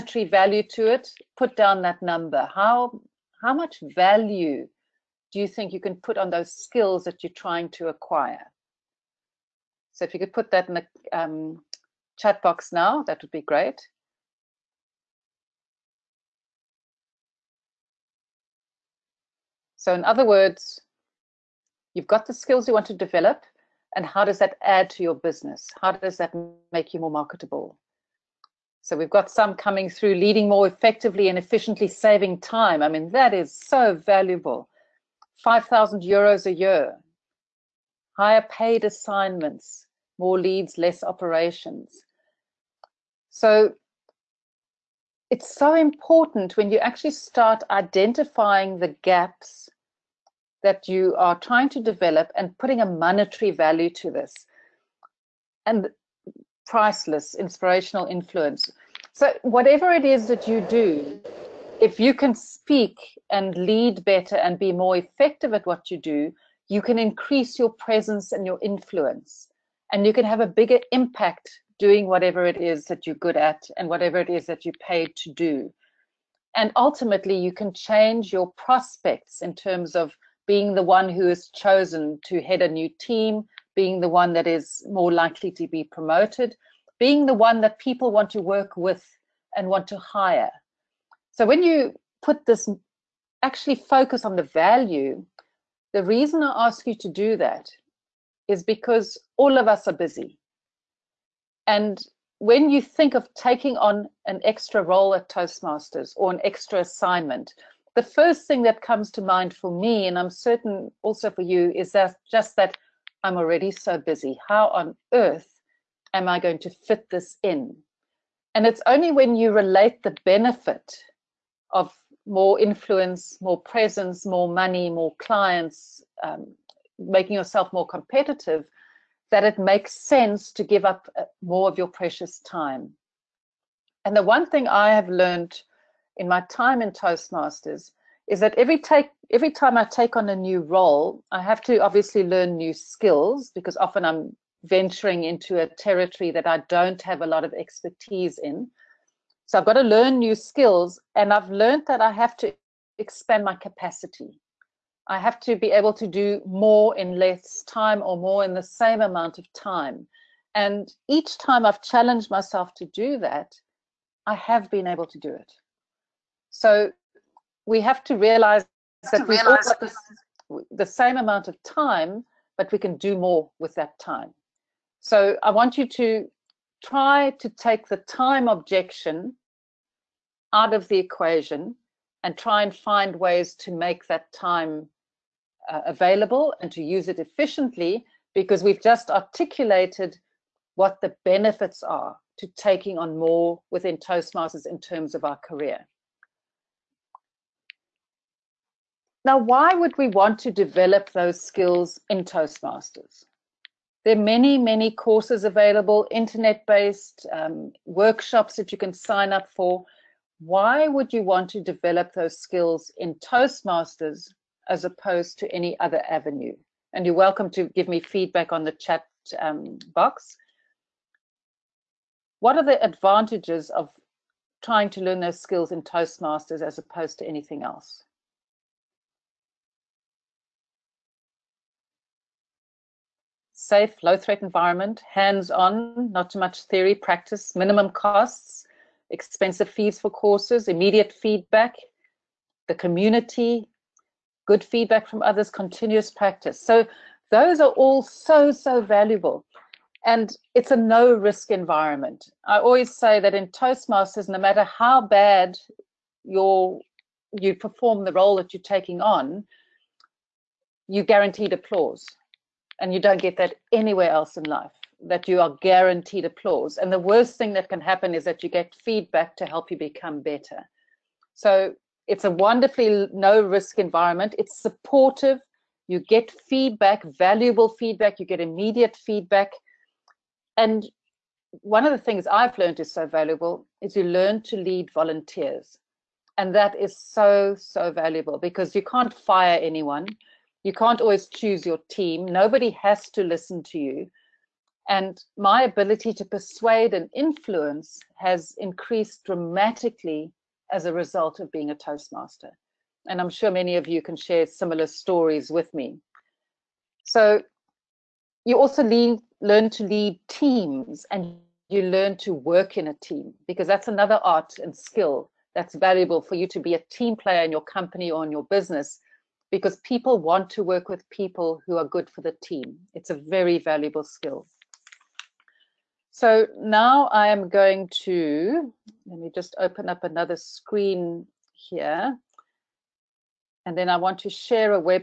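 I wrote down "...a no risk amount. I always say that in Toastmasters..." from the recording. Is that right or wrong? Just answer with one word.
wrong.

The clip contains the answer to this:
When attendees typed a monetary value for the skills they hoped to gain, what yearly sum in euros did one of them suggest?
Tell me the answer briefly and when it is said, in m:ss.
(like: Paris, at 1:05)
5,000 euros, at 0:35.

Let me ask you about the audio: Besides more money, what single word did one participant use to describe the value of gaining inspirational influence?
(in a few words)
Priceless.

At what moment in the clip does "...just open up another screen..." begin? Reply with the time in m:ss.
5:29.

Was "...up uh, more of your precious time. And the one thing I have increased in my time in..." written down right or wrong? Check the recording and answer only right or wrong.
wrong.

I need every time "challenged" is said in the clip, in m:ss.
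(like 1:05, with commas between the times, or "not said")
2:41.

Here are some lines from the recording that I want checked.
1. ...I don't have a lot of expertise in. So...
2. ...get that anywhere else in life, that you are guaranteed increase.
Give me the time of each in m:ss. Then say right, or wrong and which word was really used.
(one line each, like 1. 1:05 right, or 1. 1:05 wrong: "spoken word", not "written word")
1. 2:26 right
2. 4:23 wrong: "applause", not "increase".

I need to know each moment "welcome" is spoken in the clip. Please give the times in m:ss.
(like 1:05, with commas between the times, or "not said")
3:37.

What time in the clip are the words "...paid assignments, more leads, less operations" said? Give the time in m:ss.
0:38.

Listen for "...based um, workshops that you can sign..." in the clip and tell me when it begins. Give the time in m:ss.
3:26.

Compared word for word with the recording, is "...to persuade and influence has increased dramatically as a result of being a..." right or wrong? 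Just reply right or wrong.
right.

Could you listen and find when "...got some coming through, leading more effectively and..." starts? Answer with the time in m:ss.
0:29.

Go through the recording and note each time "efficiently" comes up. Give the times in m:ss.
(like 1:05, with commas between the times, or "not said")
0:31, 3:07.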